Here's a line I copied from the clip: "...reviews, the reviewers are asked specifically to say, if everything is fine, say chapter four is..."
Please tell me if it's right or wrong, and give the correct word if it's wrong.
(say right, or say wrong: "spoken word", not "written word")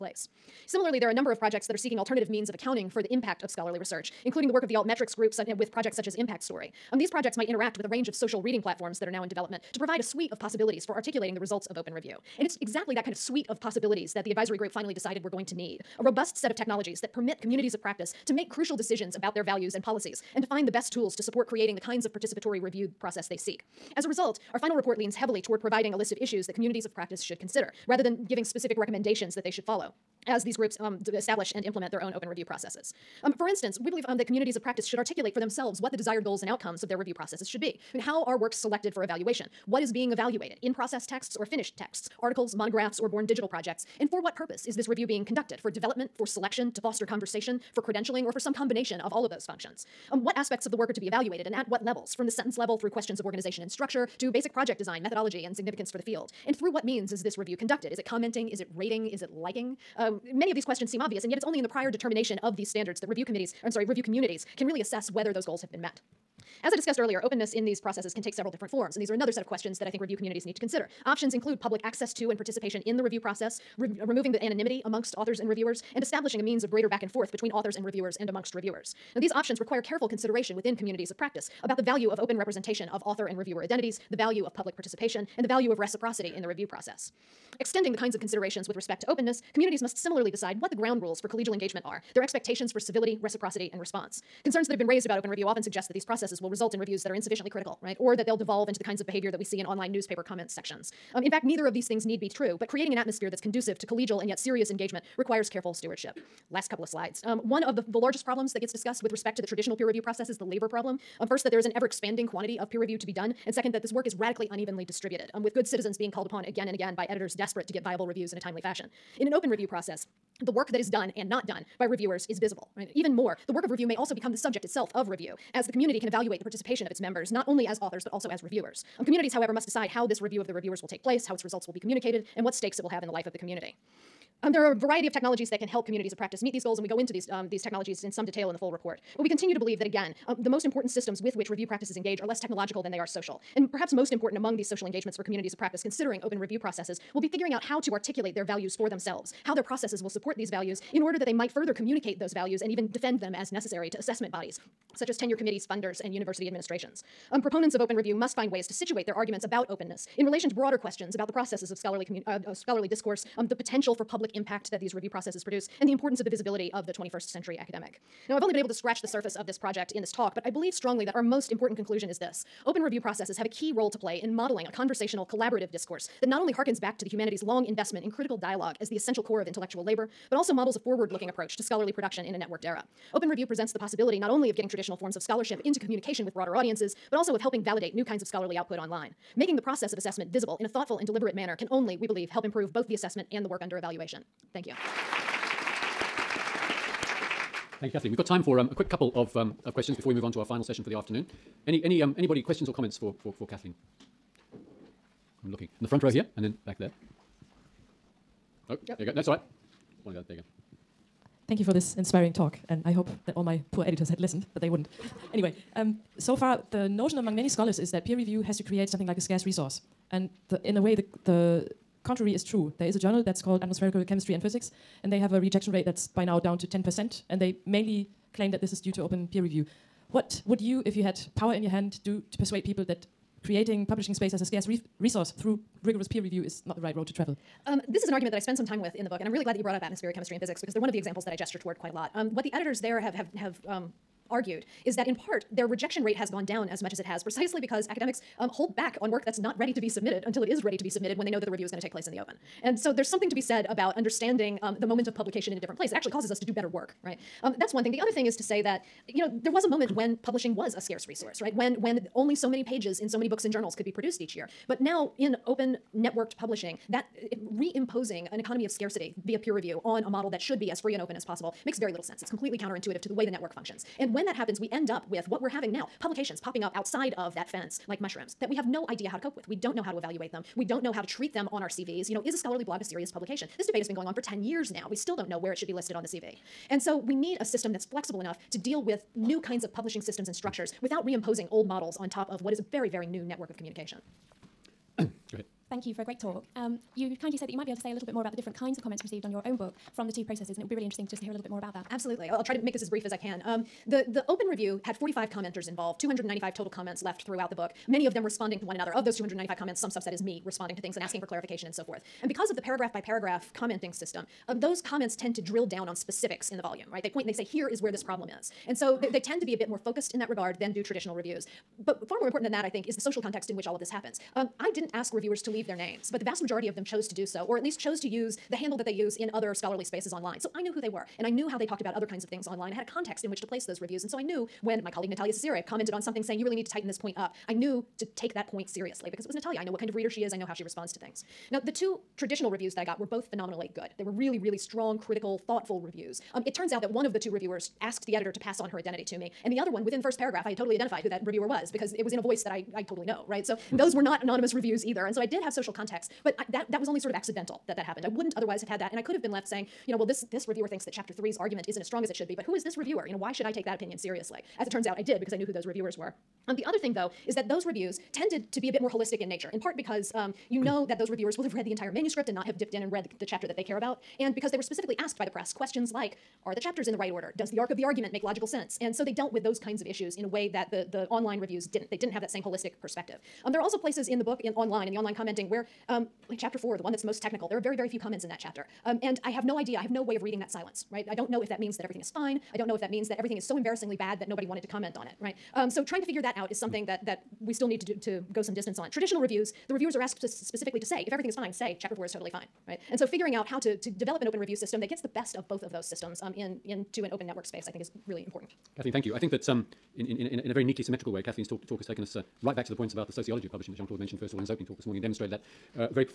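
right.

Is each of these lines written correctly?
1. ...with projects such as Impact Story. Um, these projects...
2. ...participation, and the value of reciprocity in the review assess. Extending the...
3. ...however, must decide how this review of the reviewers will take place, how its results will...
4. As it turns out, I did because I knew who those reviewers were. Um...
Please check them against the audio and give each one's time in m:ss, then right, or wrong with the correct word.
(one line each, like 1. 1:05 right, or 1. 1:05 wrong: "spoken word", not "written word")
1. 0:05 right
2. 1:24 wrong: "process", not "assess"
3. 2:09 right
4. 6:04 right.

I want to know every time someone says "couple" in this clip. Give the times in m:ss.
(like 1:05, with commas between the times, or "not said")
1:46, 3:18.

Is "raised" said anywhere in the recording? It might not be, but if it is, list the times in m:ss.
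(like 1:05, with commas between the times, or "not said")
1:34.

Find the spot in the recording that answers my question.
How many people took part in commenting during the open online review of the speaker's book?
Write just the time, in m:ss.
5:04.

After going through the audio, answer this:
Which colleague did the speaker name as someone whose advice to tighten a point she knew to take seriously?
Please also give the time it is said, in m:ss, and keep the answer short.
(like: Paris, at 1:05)
Natalia Cecire, at 5:35.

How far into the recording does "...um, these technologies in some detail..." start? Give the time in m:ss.
2:17.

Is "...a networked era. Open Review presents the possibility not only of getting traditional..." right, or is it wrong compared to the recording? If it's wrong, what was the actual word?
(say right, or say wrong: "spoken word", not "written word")
right.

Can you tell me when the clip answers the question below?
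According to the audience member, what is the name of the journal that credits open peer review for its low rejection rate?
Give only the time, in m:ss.
3:43.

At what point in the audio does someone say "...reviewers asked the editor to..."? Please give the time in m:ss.
5:47.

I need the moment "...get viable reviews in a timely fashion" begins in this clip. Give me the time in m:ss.
1:57.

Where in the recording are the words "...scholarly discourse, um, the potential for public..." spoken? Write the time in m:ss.
2:42.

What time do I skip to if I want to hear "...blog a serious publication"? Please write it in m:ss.
4:42.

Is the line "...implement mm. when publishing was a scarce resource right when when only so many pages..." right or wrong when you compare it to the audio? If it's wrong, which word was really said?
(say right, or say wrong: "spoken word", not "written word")
wrong: "moment", not "implement".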